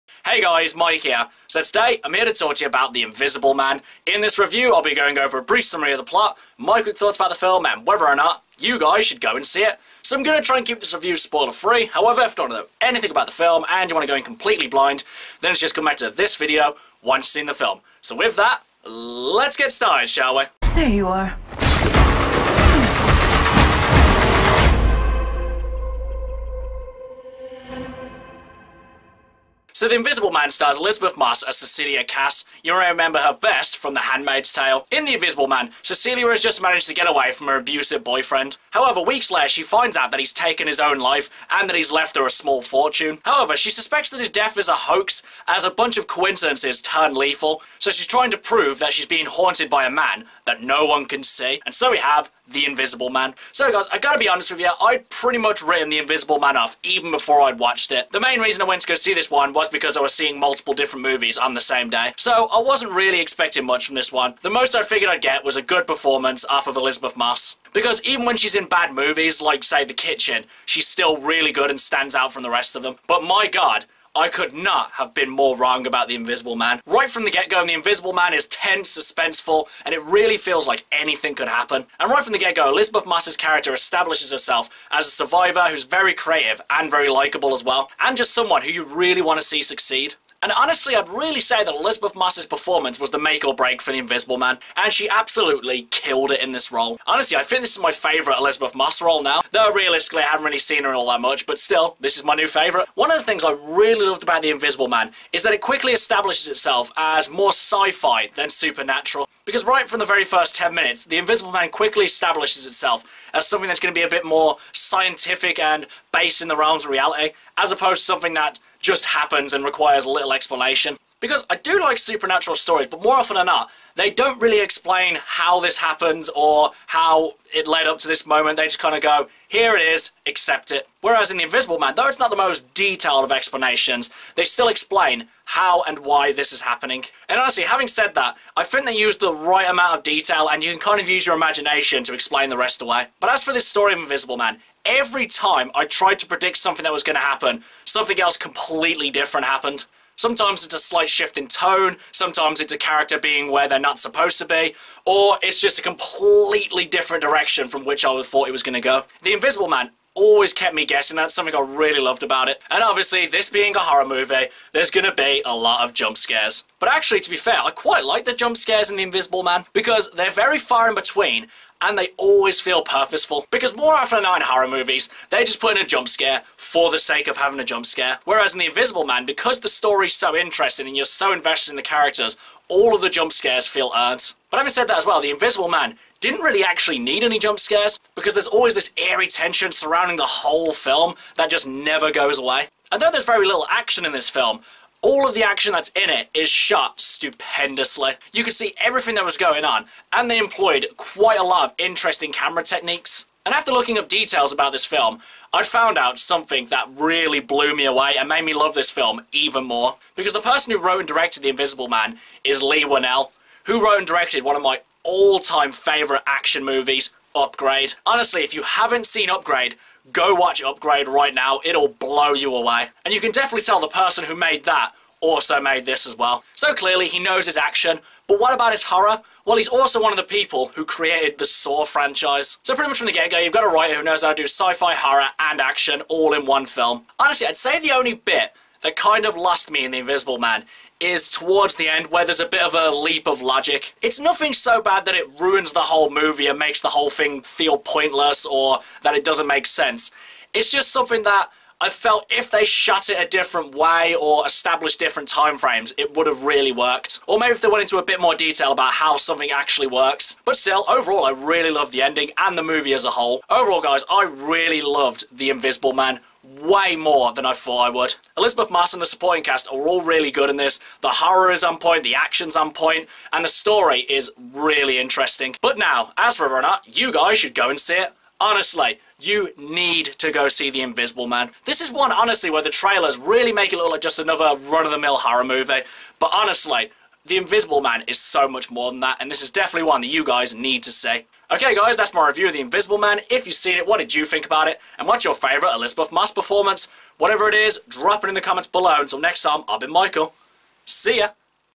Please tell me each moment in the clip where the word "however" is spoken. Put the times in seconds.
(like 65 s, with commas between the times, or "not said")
11 s, 38 s, 43 s.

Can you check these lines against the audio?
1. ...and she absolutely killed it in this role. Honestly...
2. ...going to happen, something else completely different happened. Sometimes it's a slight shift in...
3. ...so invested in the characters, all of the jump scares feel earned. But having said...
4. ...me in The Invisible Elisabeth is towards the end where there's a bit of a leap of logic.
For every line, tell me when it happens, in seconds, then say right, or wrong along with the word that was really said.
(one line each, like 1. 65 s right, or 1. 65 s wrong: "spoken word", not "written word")
1. 94 s right
2. 147 s right
3. 181 s right
4. 239 s wrong: "Man", not "Elisabeth".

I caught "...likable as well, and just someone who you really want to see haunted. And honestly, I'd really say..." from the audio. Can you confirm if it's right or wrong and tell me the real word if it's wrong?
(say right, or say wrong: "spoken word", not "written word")
wrong: "succeed", not "haunted".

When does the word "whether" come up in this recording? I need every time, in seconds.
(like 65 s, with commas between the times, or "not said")
7 s, 276 s.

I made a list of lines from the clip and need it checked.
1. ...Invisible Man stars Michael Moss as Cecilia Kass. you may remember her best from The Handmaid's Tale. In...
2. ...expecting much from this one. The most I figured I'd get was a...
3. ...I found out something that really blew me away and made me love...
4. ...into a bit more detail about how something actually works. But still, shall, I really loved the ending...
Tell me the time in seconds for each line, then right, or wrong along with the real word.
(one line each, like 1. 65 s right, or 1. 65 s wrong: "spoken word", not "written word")
1. 29 s wrong: "Elisabeth", not "Michael"
2. 63 s right
3. 205 s right
4. 257 s wrong: "overall", not "shall".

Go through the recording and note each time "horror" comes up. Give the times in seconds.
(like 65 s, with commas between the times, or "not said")
163 s, 174 s, 228 s, 234 s, 271 s, 285 s.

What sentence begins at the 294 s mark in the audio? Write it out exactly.
And what's your favourite Elisabeth Moss performance?